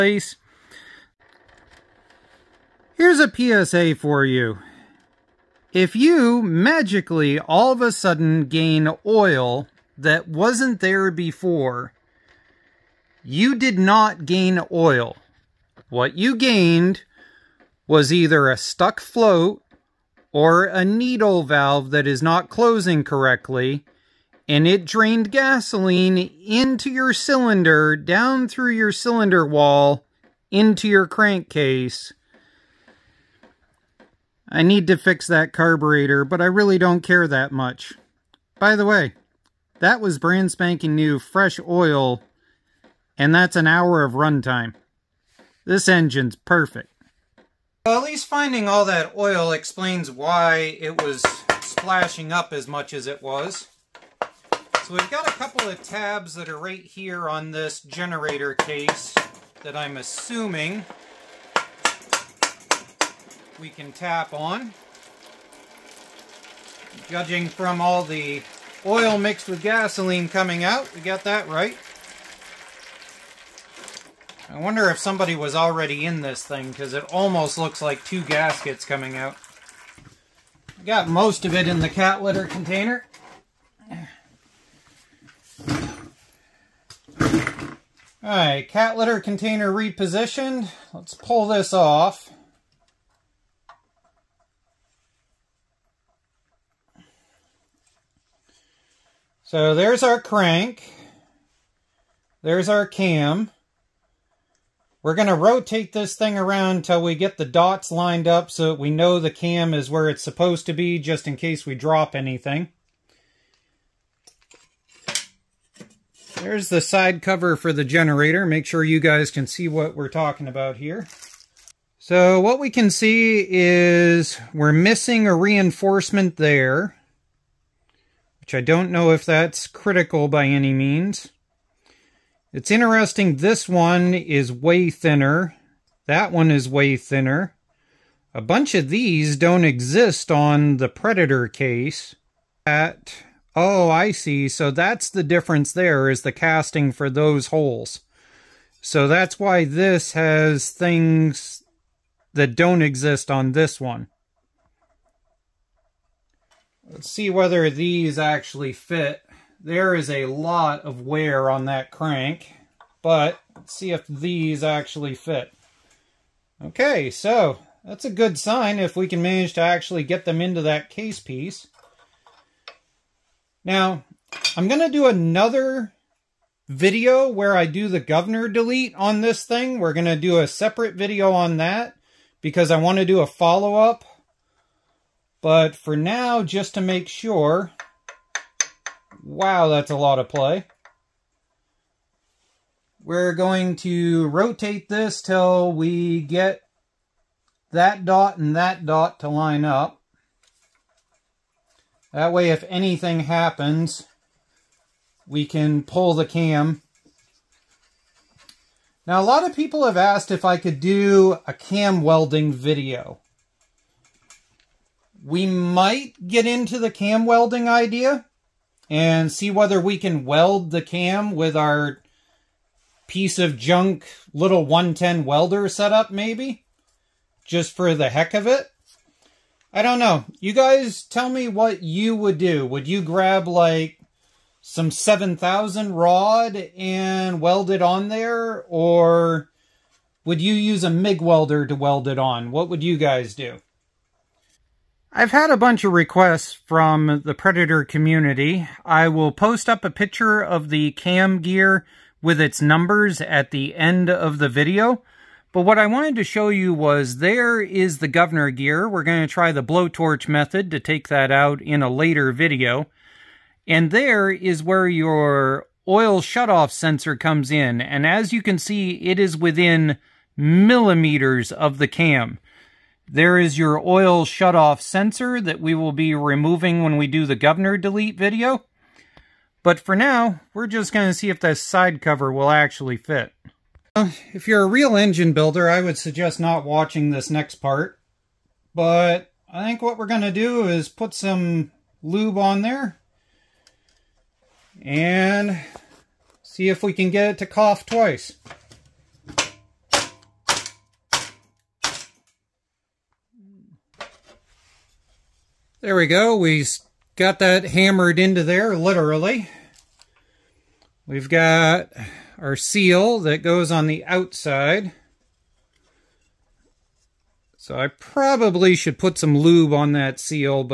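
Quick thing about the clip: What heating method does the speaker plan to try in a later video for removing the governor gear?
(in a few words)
blowtorch method.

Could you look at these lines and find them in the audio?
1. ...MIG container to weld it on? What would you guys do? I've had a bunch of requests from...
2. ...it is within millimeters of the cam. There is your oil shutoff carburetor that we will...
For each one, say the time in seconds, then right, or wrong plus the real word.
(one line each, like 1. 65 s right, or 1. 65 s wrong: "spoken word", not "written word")
1. 240 s wrong: "welder", not "container"
2. 268 s wrong: "sensor", not "carburetor".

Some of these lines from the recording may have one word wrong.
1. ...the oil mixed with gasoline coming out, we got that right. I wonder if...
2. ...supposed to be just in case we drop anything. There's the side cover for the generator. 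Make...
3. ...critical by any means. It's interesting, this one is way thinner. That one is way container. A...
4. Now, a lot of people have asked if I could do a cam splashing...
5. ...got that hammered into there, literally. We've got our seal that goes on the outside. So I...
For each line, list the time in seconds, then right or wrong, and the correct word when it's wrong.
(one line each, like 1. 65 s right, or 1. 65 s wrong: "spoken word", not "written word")
1. 68 s right
2. 110 s right
3. 129 s wrong: "thinner", not "container"
4. 209 s wrong: "welding", not "splashing"
5. 307 s right.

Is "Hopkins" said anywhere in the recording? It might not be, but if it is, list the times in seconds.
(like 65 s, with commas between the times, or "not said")
not said.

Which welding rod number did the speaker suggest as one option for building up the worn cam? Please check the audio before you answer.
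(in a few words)
7000.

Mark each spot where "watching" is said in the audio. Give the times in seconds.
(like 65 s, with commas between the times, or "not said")
286 s.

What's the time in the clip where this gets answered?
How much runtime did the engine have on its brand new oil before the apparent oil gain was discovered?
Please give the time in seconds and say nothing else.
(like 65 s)
43 s.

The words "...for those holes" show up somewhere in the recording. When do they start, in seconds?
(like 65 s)
146 s.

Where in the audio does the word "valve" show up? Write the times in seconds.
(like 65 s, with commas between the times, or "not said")
21 s.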